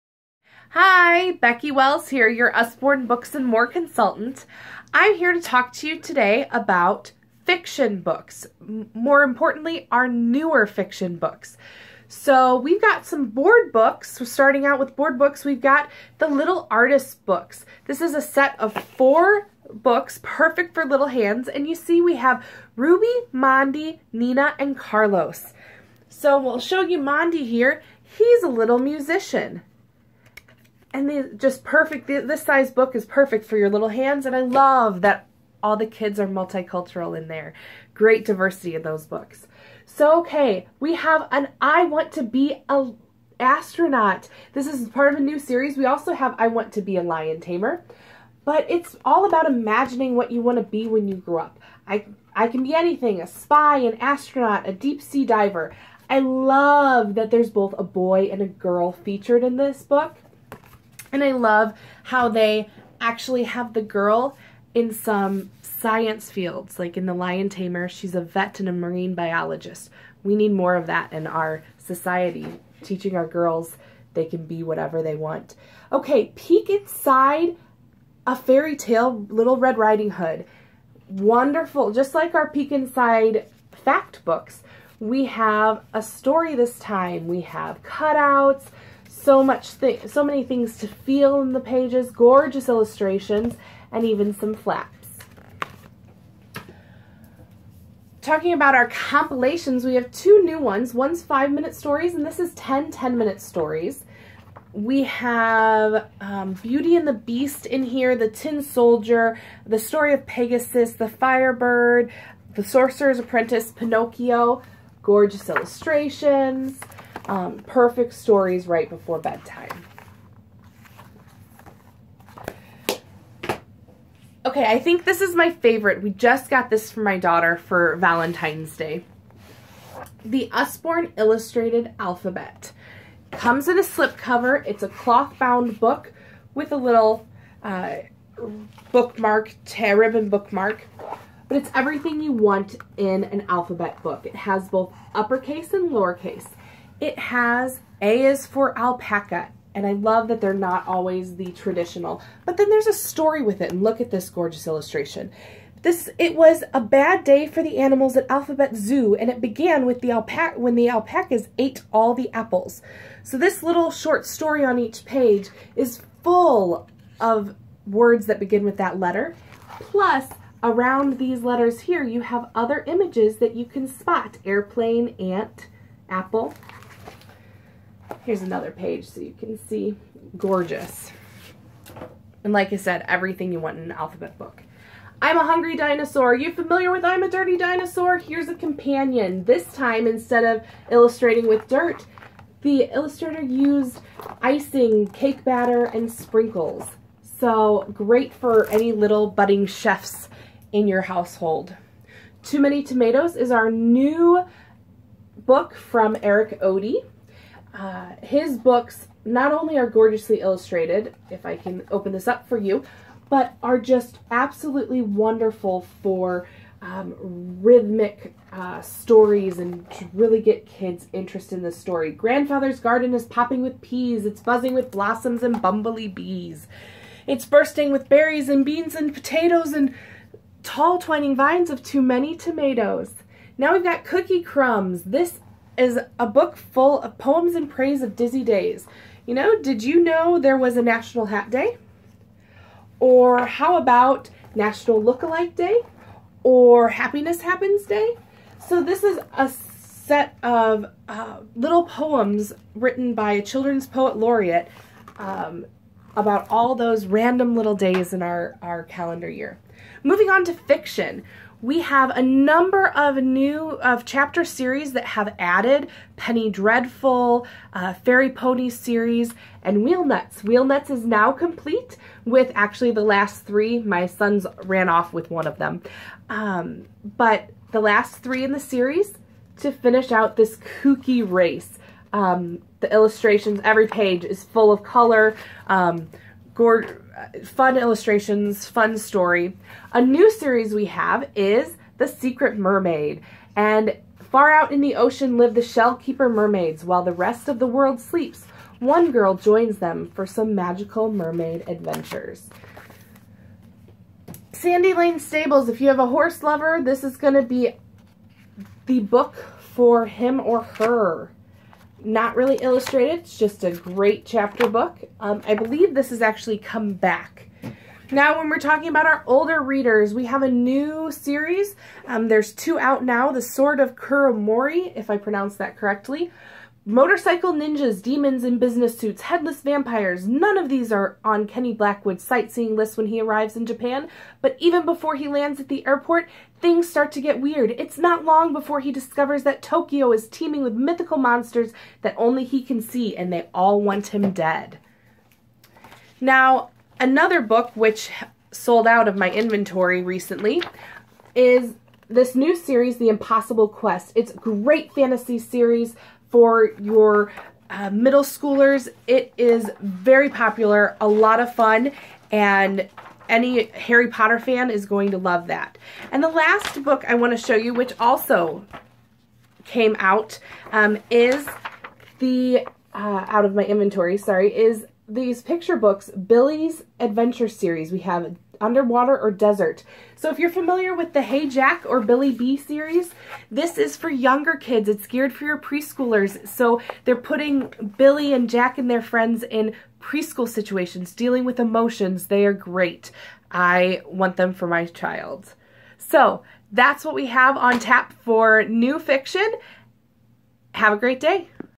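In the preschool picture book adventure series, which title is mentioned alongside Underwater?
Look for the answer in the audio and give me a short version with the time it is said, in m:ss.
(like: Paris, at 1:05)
Desert, at 6:19.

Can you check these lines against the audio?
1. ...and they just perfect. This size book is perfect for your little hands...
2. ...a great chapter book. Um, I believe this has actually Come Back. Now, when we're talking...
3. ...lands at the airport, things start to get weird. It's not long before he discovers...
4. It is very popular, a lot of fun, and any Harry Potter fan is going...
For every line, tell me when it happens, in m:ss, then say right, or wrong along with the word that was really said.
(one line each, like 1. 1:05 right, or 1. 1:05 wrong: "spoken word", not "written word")
1. 0:30 right
2. 5:13 right
3. 5:35 right
4. 5:59 right.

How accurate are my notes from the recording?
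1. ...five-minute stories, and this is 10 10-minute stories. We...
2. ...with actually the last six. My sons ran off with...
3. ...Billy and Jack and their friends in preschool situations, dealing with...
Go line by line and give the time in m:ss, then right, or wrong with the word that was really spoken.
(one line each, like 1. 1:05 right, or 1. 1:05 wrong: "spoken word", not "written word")
1. 1:41 right
2. 4:32 wrong: "three", not "six"
3. 6:27 right.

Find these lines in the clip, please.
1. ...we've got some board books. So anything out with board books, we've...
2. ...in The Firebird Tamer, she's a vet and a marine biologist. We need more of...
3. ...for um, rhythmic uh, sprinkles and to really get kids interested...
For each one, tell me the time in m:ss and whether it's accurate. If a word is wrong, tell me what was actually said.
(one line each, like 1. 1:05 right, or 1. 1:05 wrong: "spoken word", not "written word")
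1. 0:12 wrong: "starting", not "anything"
2. 1:06 wrong: "Lion", not "Firebird"
3. 3:36 wrong: "stories", not "sprinkles".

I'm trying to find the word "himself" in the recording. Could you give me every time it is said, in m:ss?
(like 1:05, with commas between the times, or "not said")
not said.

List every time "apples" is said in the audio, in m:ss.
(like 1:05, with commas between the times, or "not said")
2:42, 2:56.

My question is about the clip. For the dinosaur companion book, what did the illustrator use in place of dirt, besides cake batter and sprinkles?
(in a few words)
Icing.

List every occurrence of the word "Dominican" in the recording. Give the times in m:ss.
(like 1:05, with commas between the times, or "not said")
not said.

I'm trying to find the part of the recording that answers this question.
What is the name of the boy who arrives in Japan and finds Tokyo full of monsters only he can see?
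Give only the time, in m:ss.
5:31.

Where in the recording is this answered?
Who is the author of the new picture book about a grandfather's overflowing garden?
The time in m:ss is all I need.
3:26.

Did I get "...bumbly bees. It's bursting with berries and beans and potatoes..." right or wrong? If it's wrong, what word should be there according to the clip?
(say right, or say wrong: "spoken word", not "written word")
right.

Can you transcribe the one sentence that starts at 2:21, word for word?
But it's everything you want in an alphabet book.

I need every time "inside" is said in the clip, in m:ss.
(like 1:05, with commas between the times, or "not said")
1:16, 1:22.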